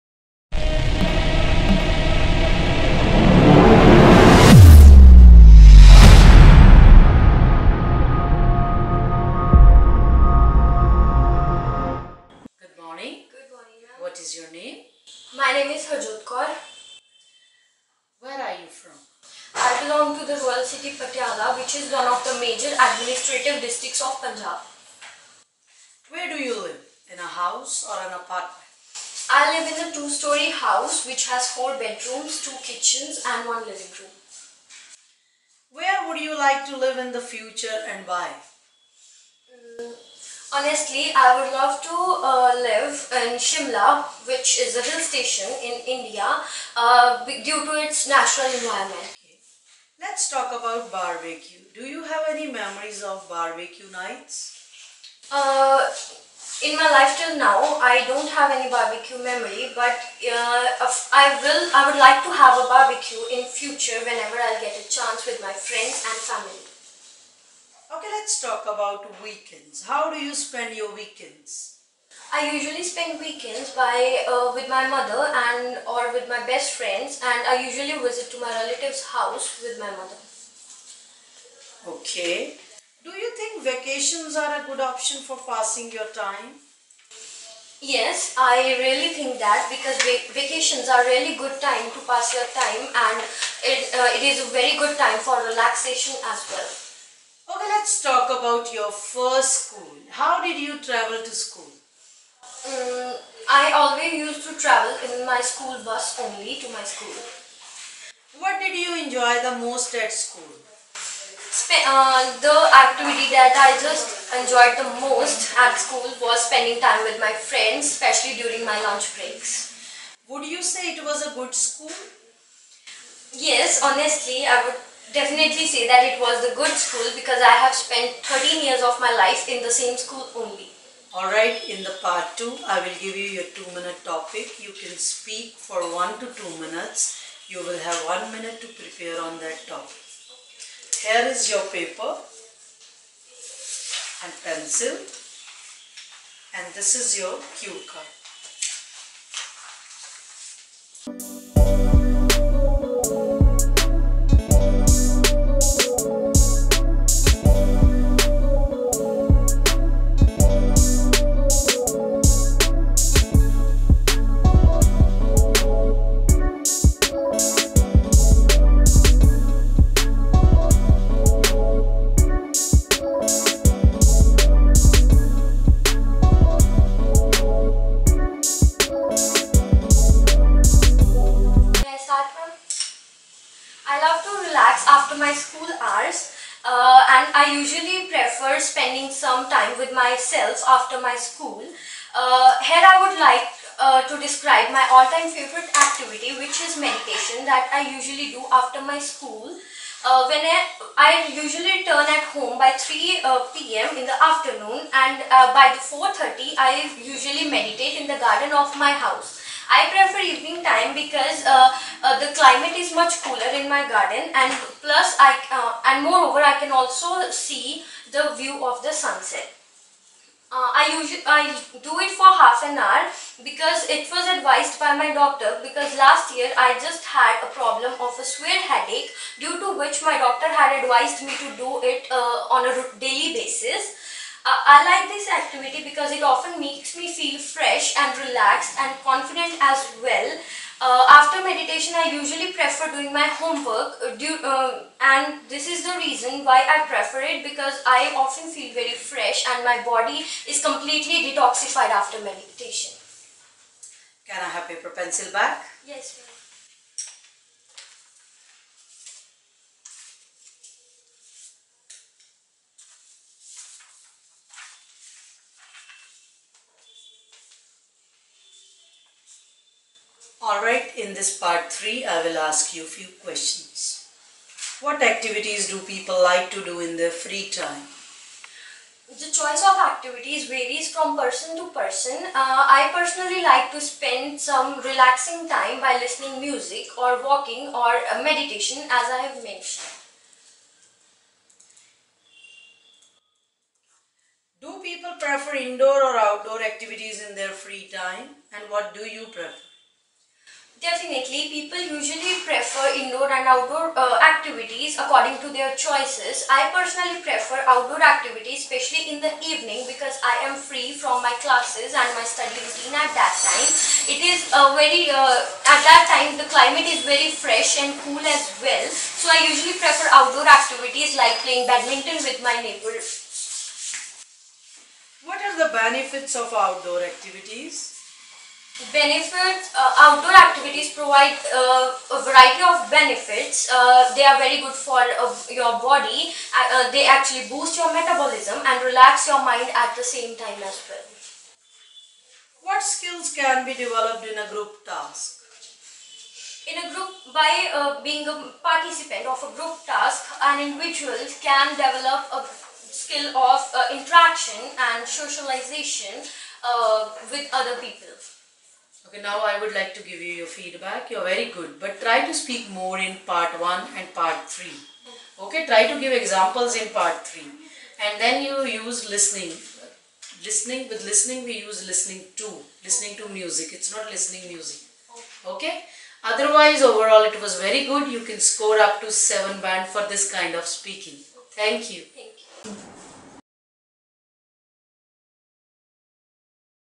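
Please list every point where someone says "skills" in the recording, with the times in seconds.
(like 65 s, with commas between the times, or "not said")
342 s, 352 s.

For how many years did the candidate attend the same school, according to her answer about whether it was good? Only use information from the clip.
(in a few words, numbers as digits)
13.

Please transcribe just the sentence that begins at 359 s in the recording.
Okay, now I would like to give you your feedback.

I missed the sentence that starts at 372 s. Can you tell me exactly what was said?
Listening to music, it's not listening music.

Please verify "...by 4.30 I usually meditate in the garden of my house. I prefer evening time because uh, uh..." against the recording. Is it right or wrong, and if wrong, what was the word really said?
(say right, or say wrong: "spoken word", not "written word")
right.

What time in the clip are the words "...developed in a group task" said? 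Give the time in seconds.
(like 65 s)
343 s.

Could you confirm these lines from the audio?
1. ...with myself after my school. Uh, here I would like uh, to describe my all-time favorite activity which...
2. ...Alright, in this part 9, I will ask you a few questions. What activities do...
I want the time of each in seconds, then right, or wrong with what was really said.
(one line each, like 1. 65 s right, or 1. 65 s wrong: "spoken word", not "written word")
1. 189 s right
2. 270 s wrong: "3", not "9".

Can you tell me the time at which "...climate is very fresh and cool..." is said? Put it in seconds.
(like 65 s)
316 s.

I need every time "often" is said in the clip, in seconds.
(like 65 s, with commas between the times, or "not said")
236 s, 248 s.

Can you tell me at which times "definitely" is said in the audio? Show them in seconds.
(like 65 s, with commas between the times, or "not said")
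125 s, 300 s.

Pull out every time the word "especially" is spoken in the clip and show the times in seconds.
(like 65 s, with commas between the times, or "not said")
117 s, 308 s.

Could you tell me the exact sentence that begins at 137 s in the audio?
You will have 1 minute to prepare on that topic.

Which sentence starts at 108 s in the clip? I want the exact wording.
What did you enjoy the most at school?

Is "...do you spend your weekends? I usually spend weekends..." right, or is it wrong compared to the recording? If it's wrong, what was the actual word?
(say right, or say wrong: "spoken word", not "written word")
right.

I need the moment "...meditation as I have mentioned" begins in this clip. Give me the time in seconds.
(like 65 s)
288 s.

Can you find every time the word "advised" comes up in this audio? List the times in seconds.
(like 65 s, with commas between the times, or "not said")
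224 s, 230 s.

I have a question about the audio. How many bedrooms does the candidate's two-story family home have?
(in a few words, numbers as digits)
4.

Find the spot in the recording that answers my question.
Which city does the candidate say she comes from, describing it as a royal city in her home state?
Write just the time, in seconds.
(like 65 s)
20 s.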